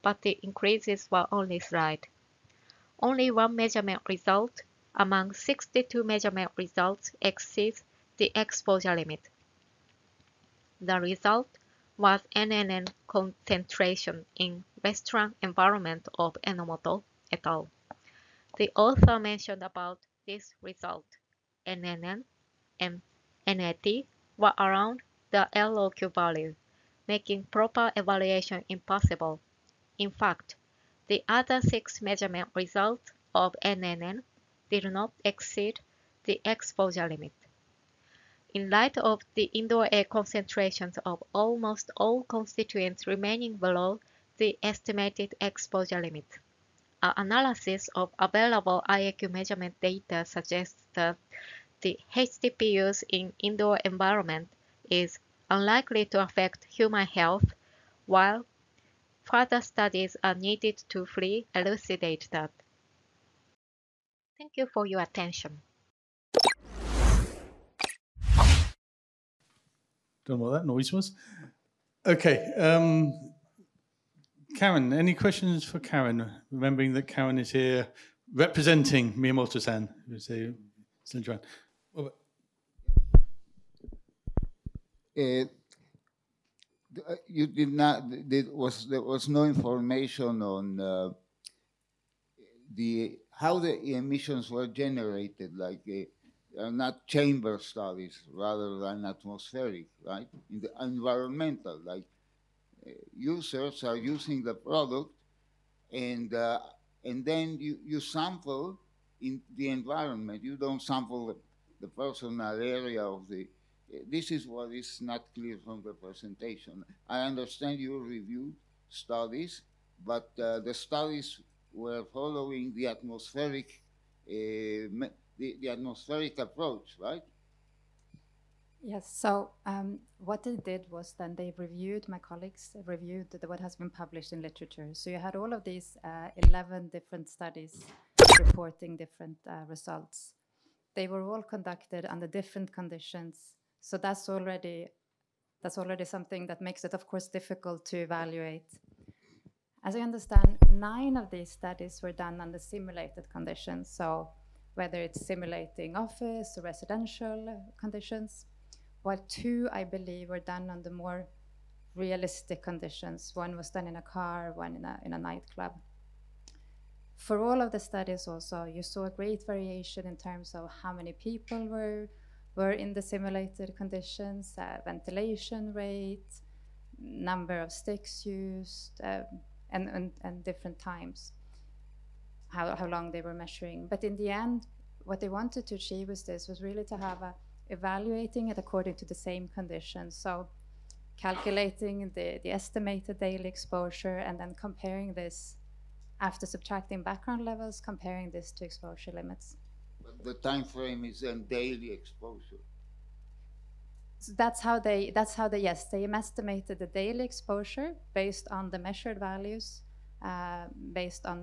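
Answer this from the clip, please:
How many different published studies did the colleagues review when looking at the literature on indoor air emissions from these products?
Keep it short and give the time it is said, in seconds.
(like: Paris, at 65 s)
11, at 136 s.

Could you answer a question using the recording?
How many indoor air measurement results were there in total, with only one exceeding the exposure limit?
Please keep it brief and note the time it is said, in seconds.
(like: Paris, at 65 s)
62, at 5 s.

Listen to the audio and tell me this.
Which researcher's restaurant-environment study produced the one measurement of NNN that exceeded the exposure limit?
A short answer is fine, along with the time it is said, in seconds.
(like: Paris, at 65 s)
Enomoto, at 16 s.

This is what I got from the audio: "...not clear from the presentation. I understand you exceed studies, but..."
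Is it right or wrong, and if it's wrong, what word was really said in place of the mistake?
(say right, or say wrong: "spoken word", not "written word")
wrong: "reviewed", not "exceed".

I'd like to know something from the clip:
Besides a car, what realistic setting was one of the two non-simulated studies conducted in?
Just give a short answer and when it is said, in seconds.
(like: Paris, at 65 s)
A nightclub, at 165 s.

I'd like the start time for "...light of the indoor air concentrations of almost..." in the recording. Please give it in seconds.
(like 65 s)
38 s.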